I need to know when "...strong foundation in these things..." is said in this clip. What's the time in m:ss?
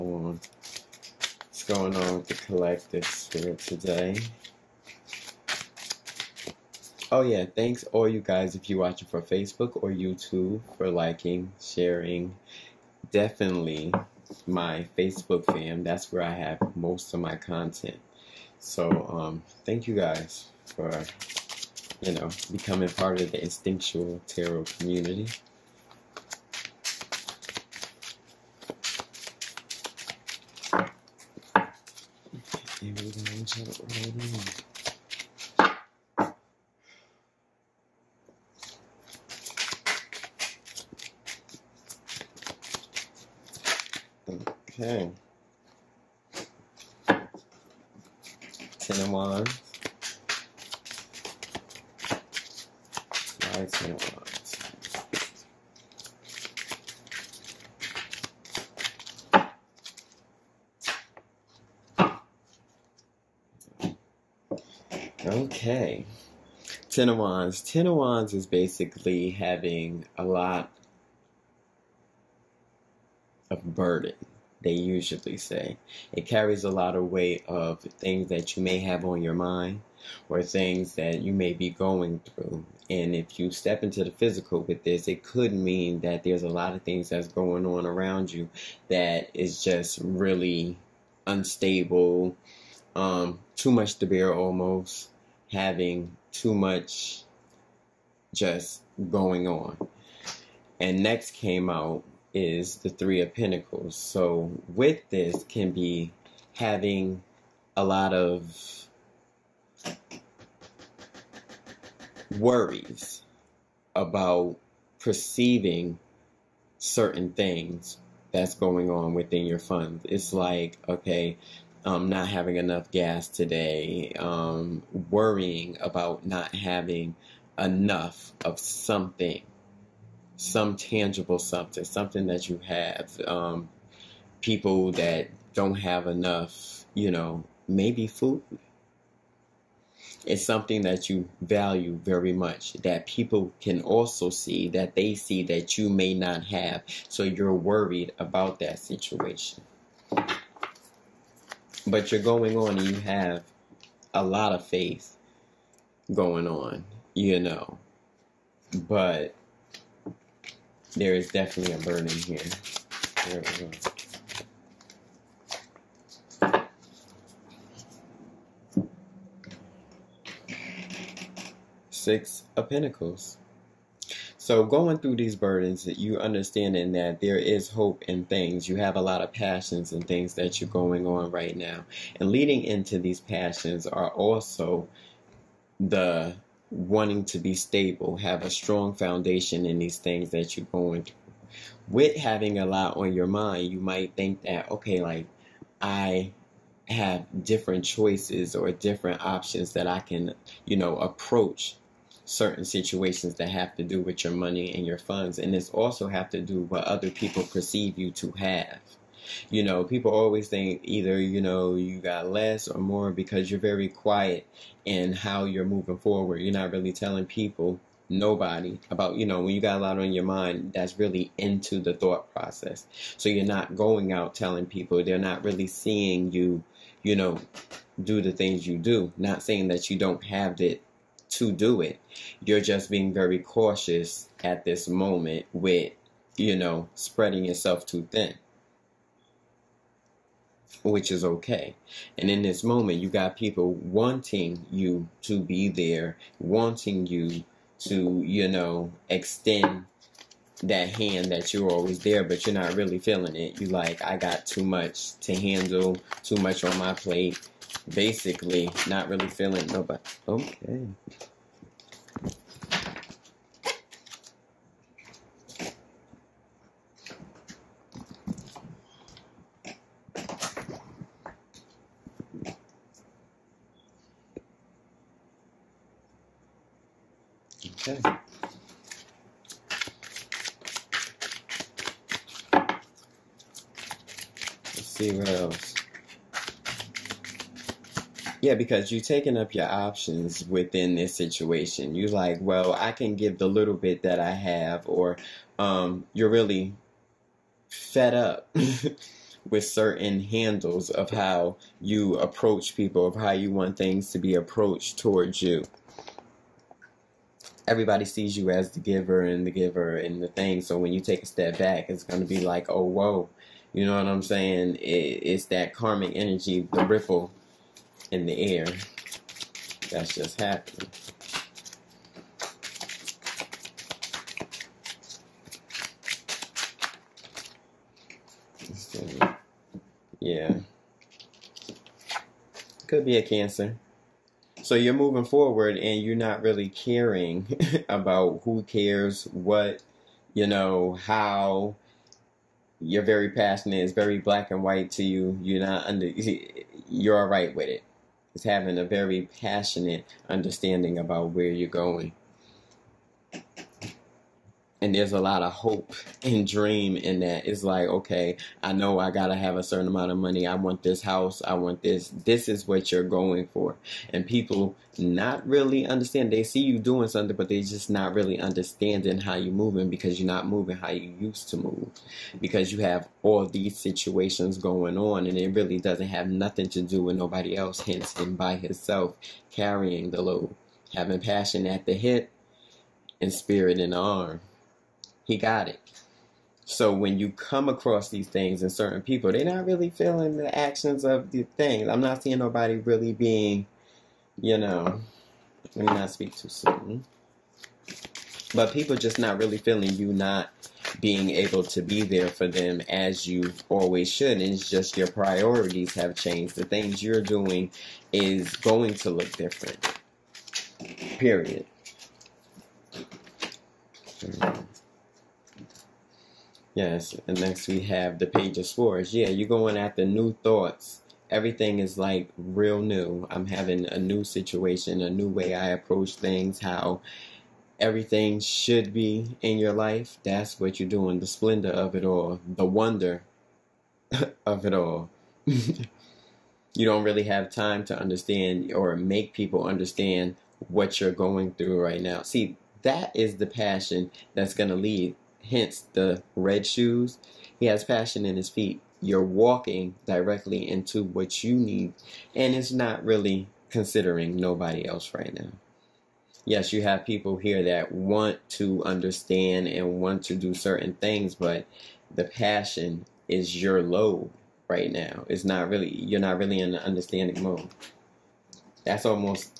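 3:08.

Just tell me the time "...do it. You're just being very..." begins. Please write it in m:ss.
3:51.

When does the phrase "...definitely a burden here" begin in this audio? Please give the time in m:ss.
2:41.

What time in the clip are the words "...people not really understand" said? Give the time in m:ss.
6:04.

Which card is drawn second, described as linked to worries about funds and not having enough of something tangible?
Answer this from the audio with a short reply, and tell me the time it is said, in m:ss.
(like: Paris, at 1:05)
Three of Pentacles, at 1:42.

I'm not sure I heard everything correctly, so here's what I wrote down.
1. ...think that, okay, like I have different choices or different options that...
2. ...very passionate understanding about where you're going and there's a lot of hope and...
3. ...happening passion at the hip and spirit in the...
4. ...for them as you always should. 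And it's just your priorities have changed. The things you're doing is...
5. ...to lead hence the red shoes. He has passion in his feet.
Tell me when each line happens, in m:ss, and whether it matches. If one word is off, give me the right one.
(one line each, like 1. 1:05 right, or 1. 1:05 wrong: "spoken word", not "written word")
1. 3:14 right
2. 5:48 right
3. 6:20 wrong: "having", not "happening"
4. 6:42 right
5. 7:24 right.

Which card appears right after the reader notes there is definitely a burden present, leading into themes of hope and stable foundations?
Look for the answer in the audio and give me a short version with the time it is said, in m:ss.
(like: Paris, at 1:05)
Six of Pentacles, at 2:51.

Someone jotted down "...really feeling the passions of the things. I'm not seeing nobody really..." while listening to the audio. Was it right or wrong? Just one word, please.
wrong.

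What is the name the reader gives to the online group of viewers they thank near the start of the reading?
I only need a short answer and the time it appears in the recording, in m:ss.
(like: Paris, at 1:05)
instinctual tarot community, at 0:23.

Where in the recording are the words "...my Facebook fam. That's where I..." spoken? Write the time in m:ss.
0:14.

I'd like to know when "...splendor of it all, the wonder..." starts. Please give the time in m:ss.
7:11.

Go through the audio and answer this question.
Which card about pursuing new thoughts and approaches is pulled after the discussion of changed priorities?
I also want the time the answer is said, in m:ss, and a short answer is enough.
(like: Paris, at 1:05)
Page of Swords, at 6:58.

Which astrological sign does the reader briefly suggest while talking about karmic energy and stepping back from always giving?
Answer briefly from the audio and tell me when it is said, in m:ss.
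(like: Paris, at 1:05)
Cancer, at 5:32.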